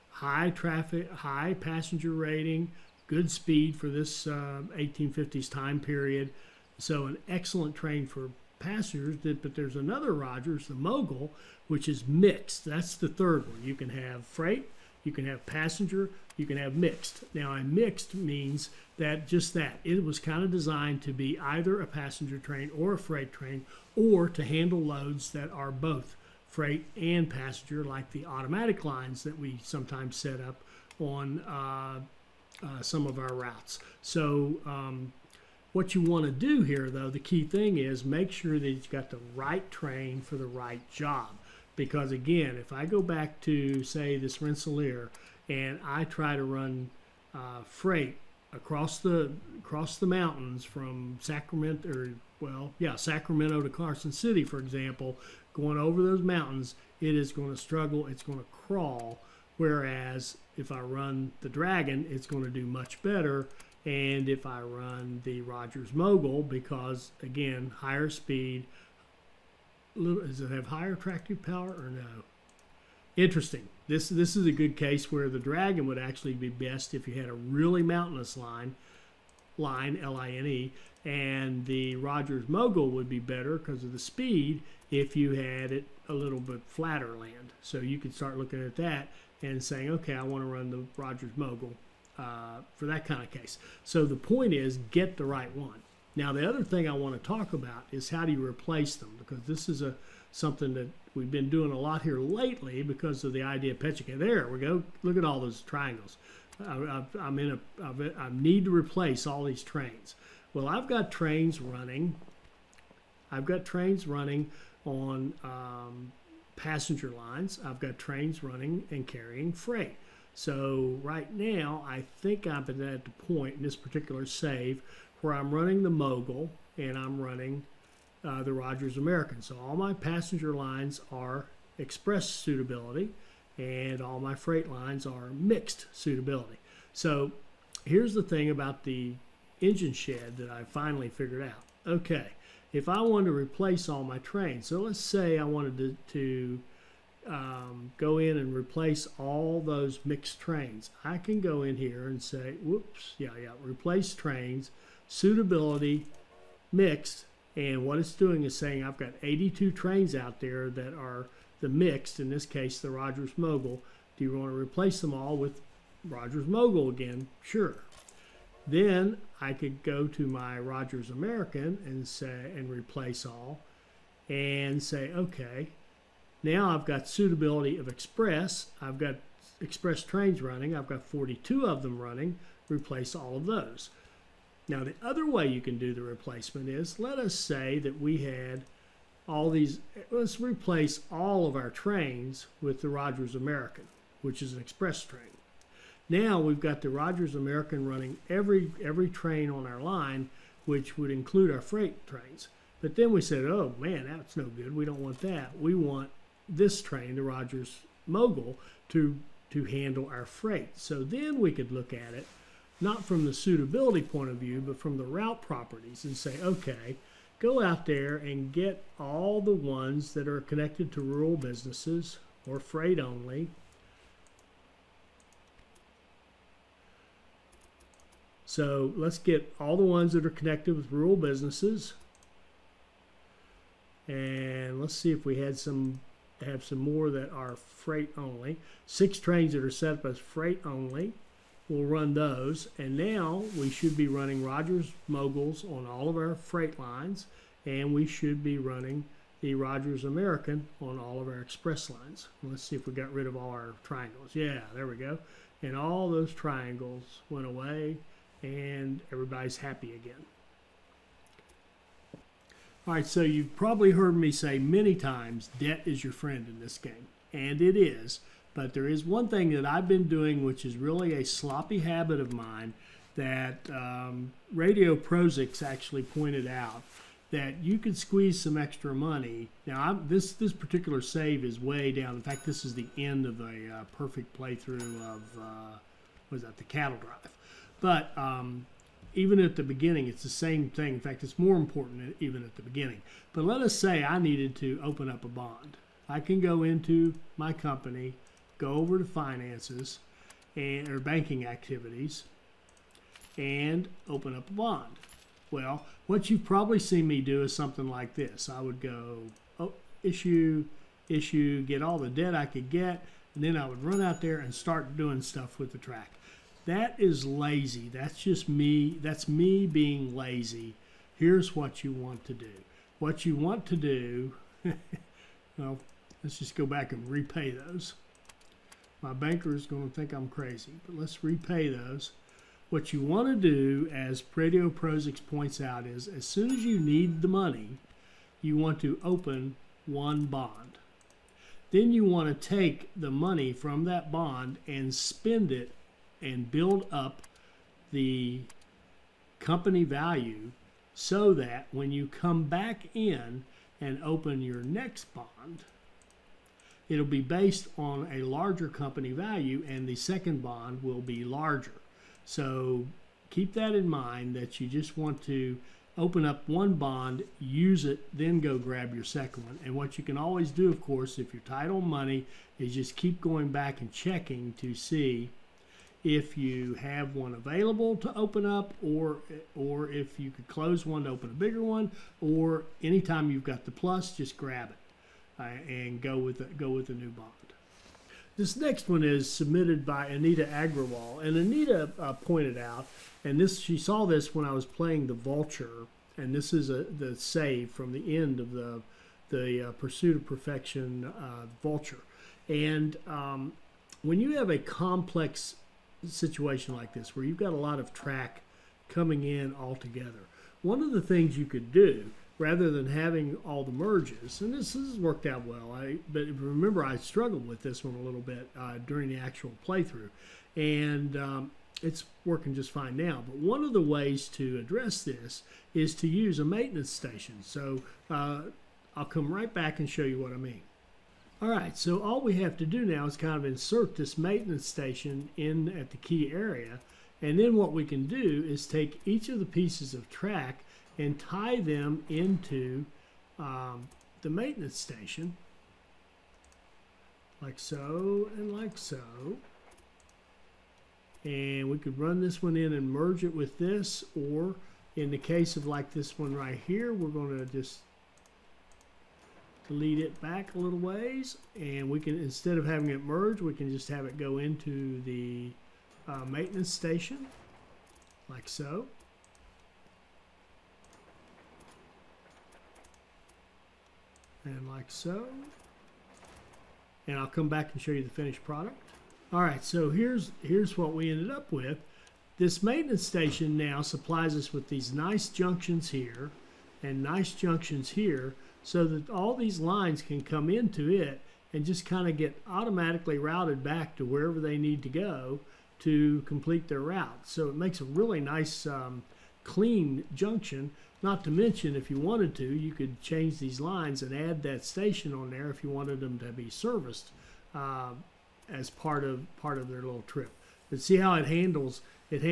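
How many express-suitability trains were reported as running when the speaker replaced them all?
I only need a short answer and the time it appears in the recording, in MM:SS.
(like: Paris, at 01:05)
42, at 03:01.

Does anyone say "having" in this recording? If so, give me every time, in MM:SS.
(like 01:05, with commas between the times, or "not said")
06:52, 07:42.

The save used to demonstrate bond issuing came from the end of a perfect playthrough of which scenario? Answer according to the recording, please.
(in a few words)
The cattle drive.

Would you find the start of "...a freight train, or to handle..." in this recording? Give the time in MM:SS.
00:22.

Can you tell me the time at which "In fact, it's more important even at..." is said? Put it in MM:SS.
04:50.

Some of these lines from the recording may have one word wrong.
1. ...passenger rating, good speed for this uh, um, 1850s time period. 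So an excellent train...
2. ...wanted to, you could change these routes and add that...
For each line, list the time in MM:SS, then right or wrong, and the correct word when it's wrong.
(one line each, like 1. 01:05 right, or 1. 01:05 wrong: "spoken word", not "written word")
1. 00:01 right
2. 08:21 wrong: "lines", not "routes".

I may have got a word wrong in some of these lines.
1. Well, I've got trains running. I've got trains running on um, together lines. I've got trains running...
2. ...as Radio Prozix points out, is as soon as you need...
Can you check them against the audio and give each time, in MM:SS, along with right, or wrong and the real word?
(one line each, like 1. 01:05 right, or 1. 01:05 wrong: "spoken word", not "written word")
1. 01:50 wrong: "passenger", not "together"
2. 05:33 right.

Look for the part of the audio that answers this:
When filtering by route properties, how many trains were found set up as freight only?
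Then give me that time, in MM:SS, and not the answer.
03:58.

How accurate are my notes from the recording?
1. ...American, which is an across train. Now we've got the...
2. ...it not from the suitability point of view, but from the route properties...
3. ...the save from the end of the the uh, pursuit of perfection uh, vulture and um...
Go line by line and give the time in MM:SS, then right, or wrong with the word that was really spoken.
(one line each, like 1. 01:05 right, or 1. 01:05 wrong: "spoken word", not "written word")
1. 03:13 wrong: "express", not "across"
2. 03:32 right
3. 06:36 right.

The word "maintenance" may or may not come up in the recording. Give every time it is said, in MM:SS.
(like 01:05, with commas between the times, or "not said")
07:06, 07:14, 07:24, 07:46, 08:02.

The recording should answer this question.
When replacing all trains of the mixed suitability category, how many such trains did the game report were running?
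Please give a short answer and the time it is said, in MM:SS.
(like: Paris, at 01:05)
82, at 02:39.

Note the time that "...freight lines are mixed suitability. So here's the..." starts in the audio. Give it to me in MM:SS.
02:14.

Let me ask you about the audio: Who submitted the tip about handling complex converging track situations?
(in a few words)
Anita Agrawal.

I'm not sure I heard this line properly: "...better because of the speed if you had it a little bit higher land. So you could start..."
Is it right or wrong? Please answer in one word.
wrong.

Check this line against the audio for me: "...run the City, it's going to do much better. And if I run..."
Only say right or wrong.
wrong.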